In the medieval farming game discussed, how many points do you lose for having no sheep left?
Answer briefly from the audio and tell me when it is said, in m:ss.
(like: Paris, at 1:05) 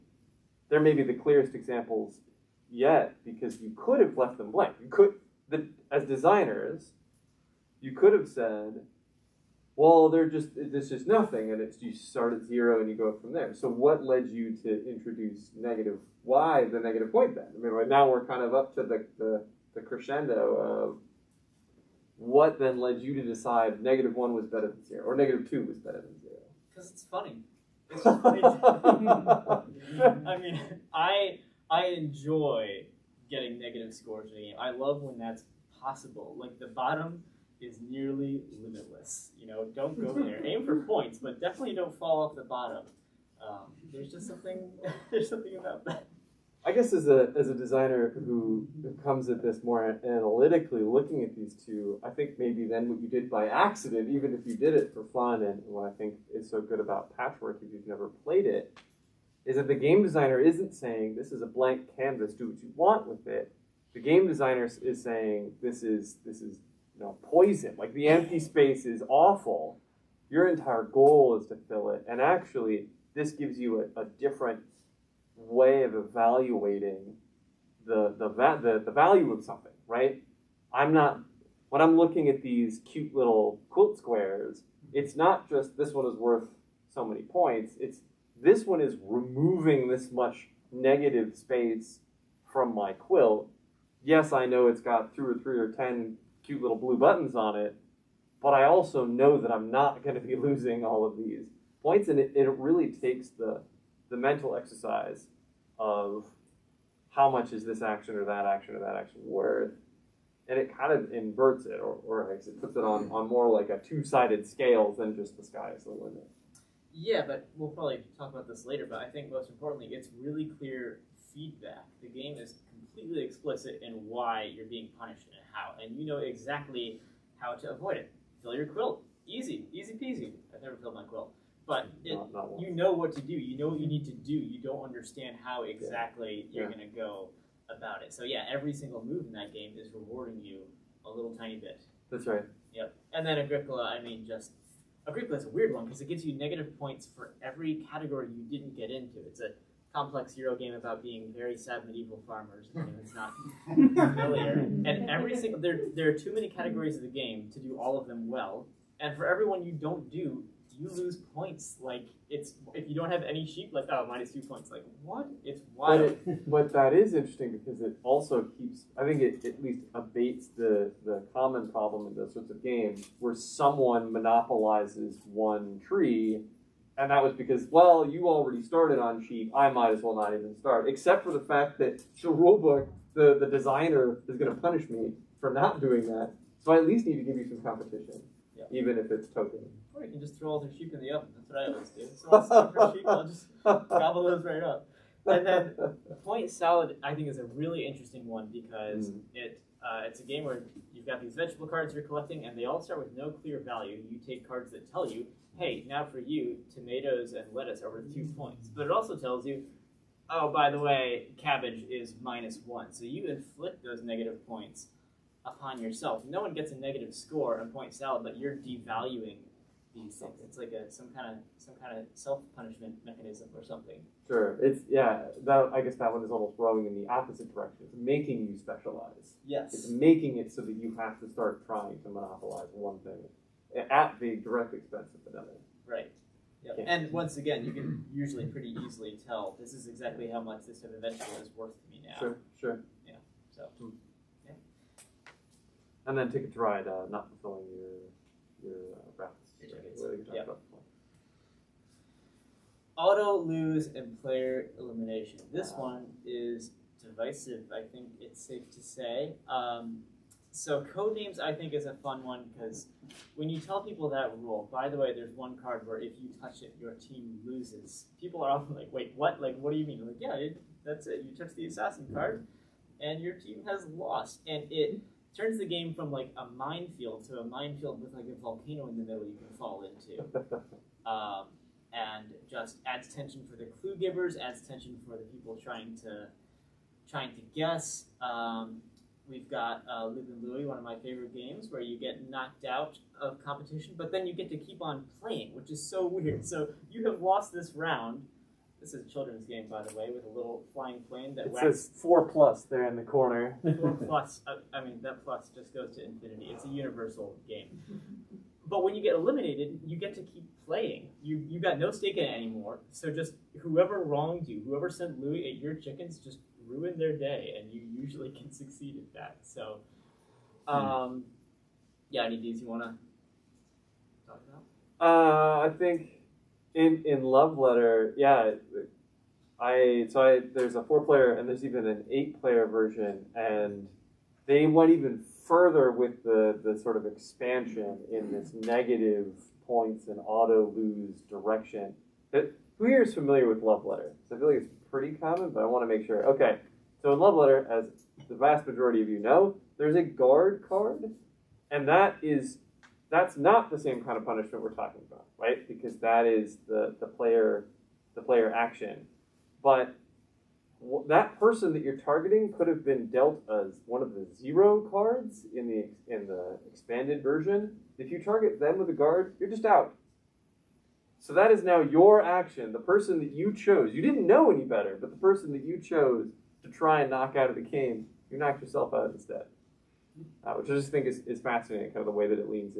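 2, at 2:44.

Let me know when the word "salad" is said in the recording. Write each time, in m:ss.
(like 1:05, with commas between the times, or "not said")
3:16, 3:37.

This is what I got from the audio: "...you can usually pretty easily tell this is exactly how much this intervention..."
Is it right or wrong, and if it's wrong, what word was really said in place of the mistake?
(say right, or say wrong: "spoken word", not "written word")
right.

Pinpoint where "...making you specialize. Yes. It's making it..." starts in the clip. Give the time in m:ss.
3:47.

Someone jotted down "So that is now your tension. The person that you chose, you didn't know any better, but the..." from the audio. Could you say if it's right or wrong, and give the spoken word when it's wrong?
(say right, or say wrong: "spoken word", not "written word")
wrong: "action", not "tension".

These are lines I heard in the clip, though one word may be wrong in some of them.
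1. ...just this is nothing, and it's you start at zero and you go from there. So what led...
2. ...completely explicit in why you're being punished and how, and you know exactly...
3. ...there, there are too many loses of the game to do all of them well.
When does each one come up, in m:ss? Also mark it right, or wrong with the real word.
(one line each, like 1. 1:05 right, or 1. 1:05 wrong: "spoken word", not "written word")
1. 0:10 right
2. 2:02 right
3. 2:35 wrong: "categories", not "loses".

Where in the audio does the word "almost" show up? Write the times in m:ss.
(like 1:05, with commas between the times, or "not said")
3:46.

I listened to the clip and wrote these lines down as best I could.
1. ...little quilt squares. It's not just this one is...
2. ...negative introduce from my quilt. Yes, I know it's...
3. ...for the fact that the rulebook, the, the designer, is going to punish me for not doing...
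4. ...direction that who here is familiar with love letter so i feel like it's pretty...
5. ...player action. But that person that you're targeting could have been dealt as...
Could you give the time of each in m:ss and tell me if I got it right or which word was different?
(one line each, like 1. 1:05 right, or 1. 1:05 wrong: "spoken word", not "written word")
1. 1:23 right
2. 1:30 wrong: "space", not "introduce"
3. 3:01 right
4. 5:41 right
5. 5:58 right.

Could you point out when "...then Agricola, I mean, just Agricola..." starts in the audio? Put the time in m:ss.
2:23.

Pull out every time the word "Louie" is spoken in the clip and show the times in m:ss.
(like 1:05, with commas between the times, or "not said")
4:50, 5:15.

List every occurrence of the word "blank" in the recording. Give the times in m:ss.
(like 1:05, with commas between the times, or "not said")
0:04, 1:01.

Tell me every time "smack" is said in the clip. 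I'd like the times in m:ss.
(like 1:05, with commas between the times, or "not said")
not said.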